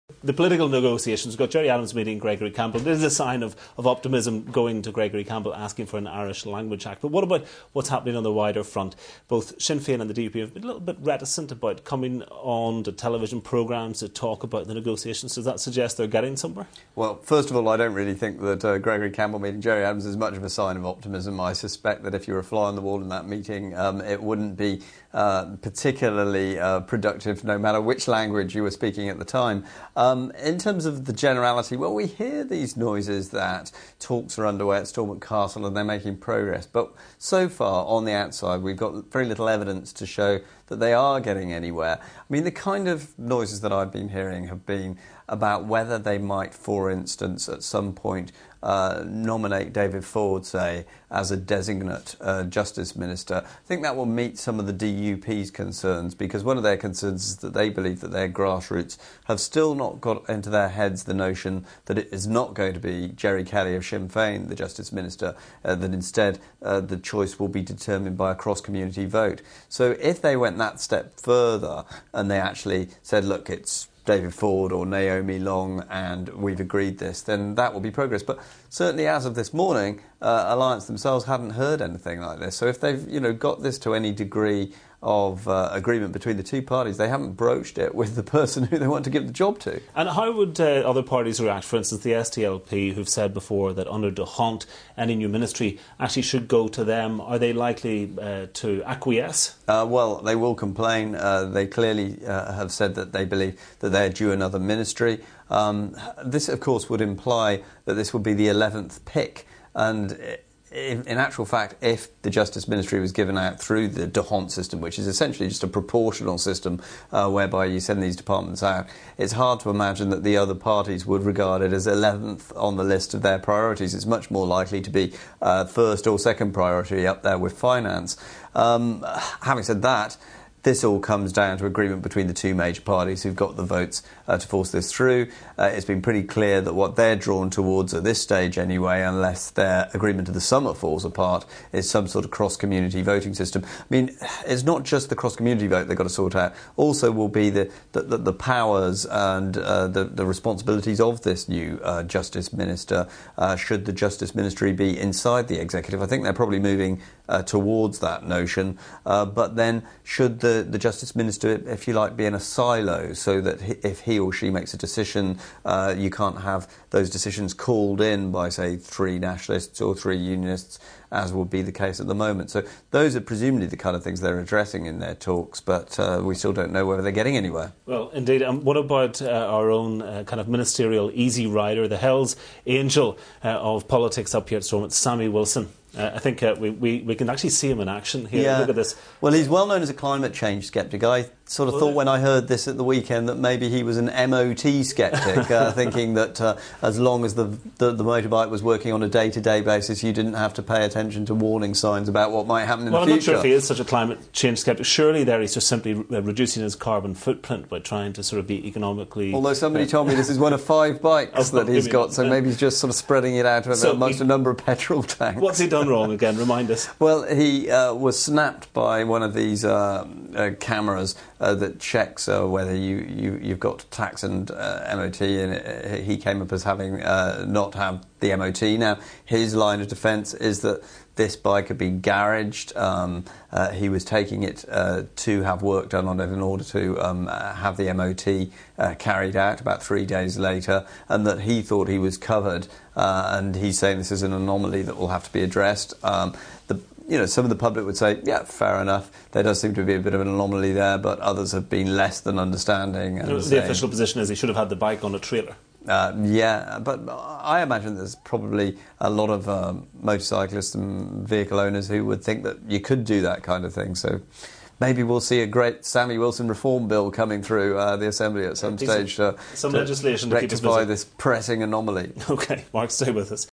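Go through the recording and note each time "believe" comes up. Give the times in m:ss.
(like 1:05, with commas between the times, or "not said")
0:57, 1:43.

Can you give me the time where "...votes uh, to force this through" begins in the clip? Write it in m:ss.
2:13.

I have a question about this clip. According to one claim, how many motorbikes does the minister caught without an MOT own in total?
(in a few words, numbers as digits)
5.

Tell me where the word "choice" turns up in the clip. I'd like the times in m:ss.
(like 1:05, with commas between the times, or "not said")
1:06.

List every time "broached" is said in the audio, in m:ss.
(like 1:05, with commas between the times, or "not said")
1:27.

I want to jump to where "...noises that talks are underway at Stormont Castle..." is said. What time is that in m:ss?
0:32.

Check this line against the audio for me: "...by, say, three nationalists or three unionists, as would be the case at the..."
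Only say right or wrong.
right.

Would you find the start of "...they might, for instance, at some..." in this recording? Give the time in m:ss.
0:45.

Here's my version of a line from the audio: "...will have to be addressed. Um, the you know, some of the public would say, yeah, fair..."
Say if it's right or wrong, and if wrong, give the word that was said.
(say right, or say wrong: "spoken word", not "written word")
right.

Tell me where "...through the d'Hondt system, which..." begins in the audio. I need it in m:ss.
1:53.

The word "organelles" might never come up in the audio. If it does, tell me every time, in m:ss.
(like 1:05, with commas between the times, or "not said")
not said.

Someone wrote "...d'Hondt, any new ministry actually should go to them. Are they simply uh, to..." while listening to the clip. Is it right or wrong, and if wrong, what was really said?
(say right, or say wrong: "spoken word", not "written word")
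wrong: "likely", not "simply".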